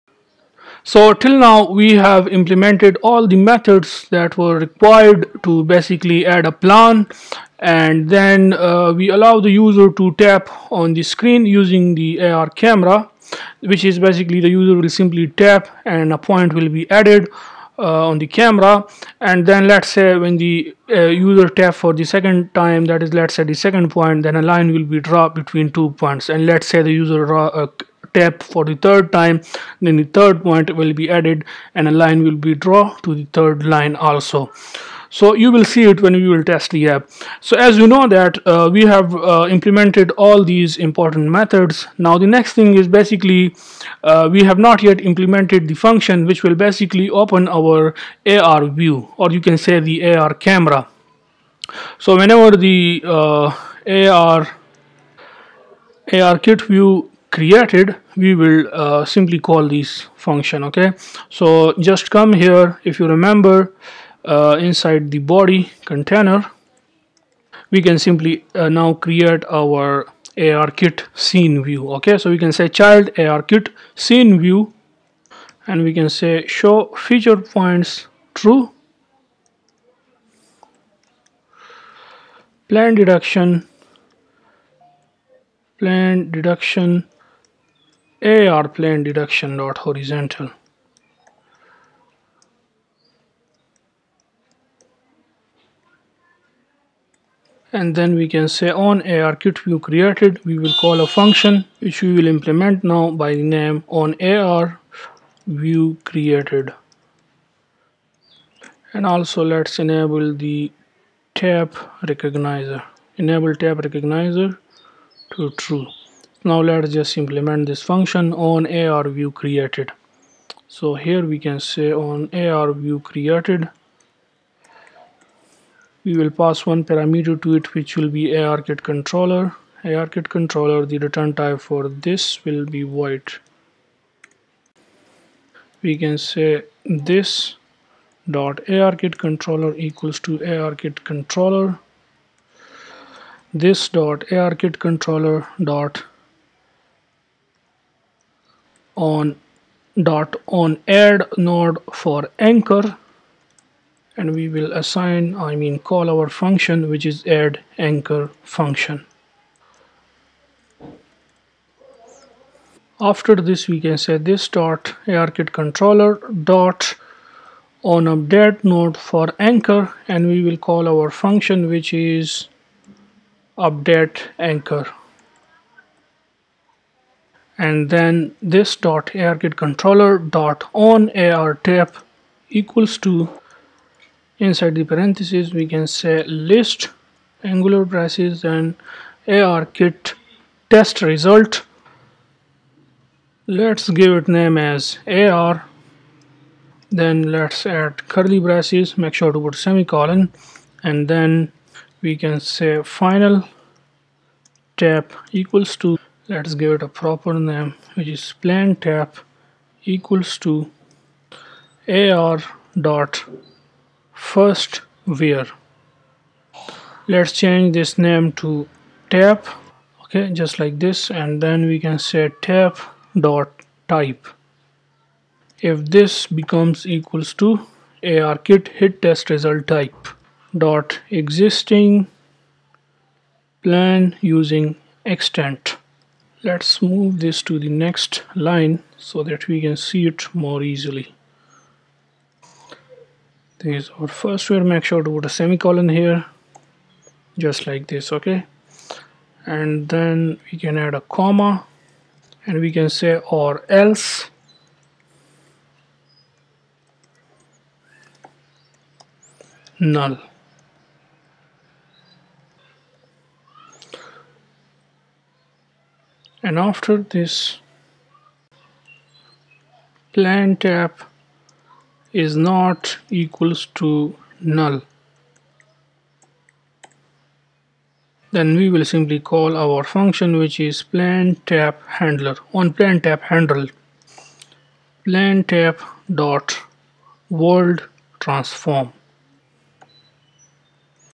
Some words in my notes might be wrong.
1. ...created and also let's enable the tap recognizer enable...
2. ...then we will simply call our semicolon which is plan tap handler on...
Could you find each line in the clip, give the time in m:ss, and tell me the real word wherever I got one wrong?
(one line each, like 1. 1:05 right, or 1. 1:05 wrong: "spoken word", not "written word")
1. 1:46 right
2. 4:38 wrong: "function", not "semicolon".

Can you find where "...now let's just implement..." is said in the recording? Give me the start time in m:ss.
1:56.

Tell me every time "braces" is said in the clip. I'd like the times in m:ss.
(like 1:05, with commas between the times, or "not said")
3:07, 3:18.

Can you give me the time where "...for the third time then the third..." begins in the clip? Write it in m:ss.
0:28.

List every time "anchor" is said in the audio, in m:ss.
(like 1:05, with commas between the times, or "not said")
2:32, 2:37, 2:49, 2:54.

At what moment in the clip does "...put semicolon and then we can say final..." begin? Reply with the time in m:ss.
3:19.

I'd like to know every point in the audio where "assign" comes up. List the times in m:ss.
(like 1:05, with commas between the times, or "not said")
2:34.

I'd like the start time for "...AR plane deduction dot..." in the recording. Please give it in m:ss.
1:28.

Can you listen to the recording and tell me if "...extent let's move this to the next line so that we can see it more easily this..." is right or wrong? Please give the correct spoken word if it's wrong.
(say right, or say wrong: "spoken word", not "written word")
right.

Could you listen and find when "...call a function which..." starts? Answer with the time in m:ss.
1:40.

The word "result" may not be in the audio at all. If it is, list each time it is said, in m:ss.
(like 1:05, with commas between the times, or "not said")
3:11, 3:49.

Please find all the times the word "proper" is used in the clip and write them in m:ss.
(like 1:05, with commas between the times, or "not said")
3:26.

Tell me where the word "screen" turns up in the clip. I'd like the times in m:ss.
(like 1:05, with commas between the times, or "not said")
0:11.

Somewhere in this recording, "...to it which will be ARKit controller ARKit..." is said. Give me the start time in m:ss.
2:07.